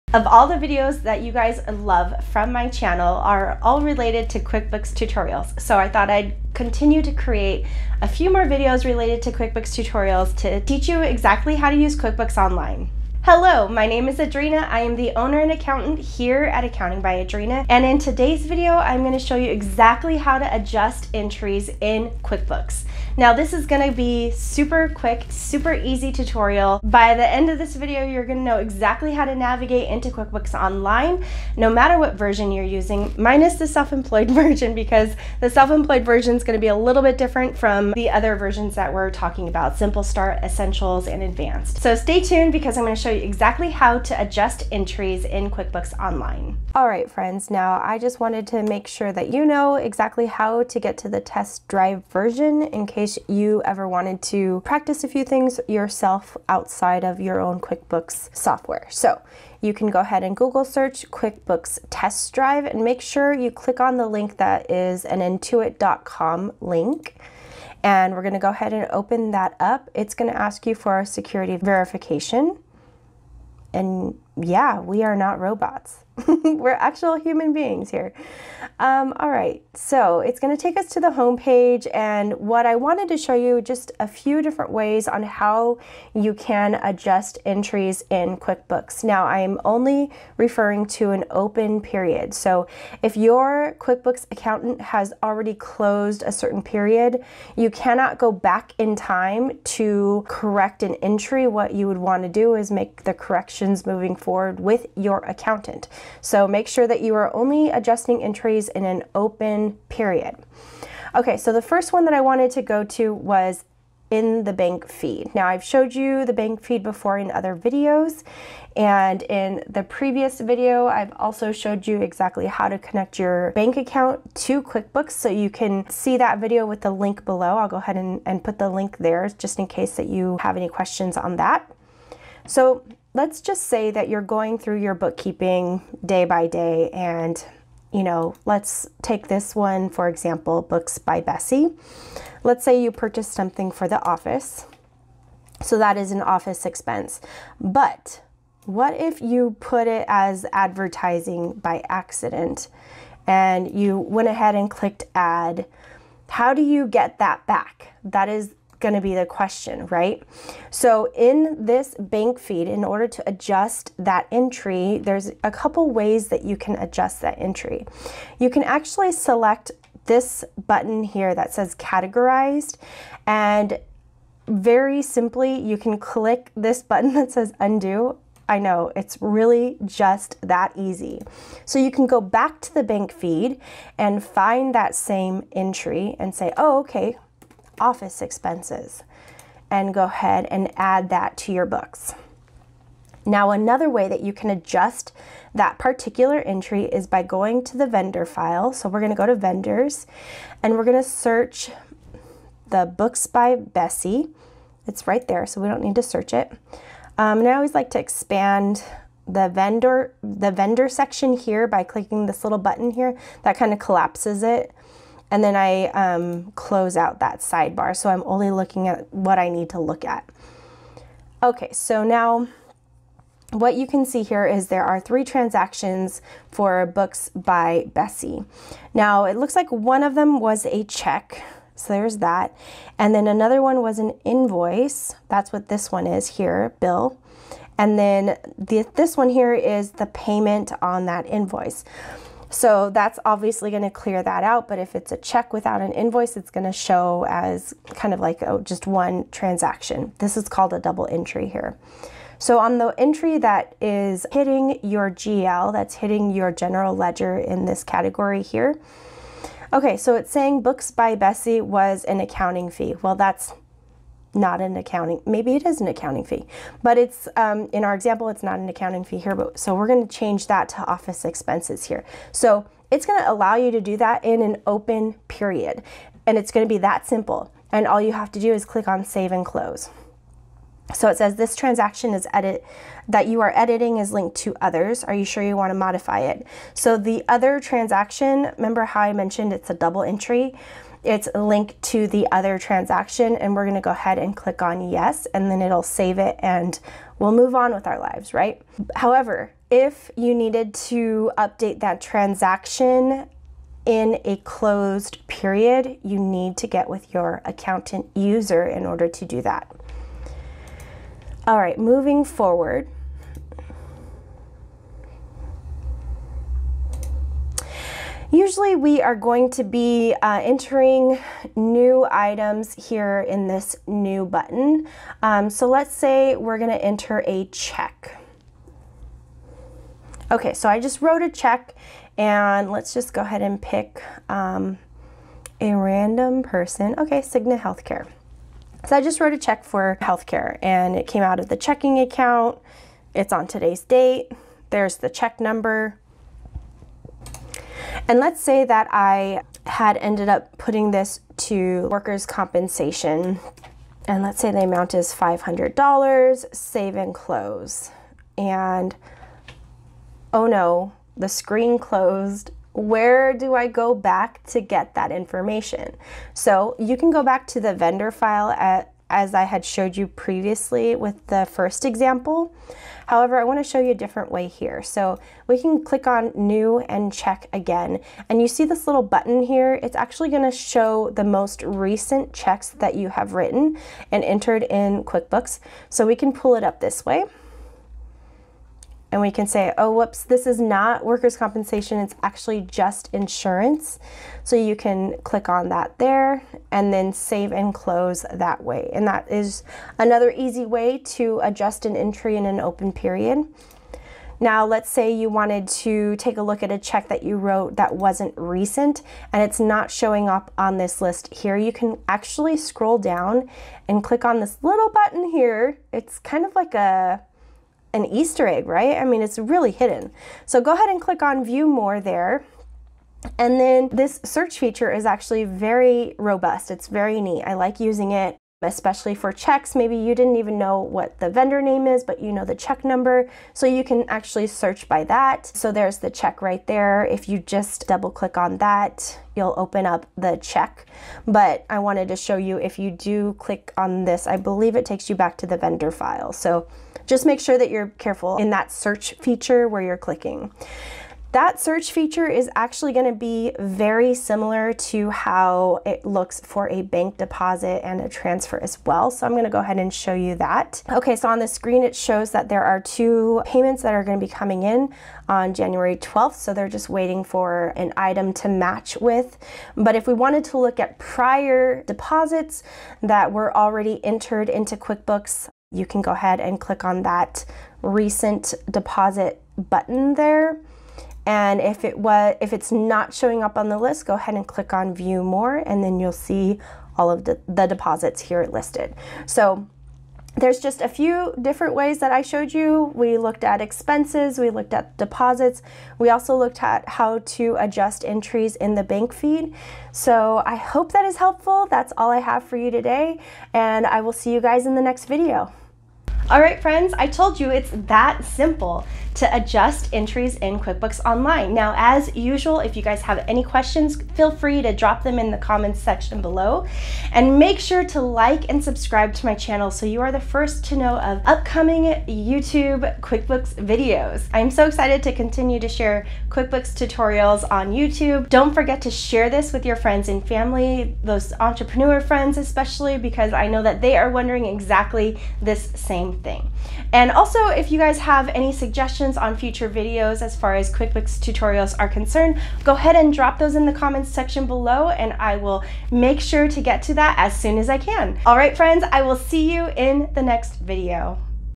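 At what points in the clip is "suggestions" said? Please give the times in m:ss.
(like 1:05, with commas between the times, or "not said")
8:58.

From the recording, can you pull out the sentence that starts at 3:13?
Now, another way that you can adjust that particular entry is by going to the vendor file.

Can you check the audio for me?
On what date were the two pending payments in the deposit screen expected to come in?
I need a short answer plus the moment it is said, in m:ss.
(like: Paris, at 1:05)
January 12, at 7:45.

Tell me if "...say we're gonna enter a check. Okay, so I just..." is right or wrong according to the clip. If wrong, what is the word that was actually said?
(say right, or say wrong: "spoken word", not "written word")
right.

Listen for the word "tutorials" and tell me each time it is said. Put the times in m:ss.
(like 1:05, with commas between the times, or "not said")
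0:04, 0:09, 0:26, 8:46, 9:01.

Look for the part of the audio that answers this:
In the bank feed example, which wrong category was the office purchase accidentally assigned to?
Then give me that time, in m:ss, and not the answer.
2:30.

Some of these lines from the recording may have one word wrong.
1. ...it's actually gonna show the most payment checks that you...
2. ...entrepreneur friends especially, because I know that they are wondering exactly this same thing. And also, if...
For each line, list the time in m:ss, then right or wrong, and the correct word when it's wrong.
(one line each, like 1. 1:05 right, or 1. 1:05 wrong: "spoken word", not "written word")
1. 6:19 wrong: "recent", not "payment"
2. 8:51 right.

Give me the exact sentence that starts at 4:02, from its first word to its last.
So that's obviously going to clear that out.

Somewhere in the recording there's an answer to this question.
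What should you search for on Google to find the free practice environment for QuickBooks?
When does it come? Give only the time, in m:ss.
1:01.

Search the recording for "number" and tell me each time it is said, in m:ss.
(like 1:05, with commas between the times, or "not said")
5:45, 7:12.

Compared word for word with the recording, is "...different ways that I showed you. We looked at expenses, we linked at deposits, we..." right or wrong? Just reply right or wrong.
wrong.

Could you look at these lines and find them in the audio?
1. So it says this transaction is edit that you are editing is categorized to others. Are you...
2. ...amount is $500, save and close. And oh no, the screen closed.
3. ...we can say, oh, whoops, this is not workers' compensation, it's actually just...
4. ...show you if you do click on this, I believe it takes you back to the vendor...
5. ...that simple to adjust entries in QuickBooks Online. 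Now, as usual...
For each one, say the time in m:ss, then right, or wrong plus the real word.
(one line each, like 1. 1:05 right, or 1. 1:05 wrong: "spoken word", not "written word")
1. 4:40 wrong: "linked", not "categorized"
2. 5:54 right
3. 6:29 right
4. 7:22 right
5. 8:27 right.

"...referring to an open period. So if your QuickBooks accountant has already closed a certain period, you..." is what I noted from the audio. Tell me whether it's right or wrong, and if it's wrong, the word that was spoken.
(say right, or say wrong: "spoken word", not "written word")
right.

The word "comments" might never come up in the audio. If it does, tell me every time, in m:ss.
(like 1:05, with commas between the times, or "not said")
8:35, 9:03.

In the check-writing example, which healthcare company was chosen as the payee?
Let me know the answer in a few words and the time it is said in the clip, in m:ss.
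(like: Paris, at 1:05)
Cigna Healthcare, at 5:37.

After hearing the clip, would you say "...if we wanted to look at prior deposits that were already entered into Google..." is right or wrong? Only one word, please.
wrong.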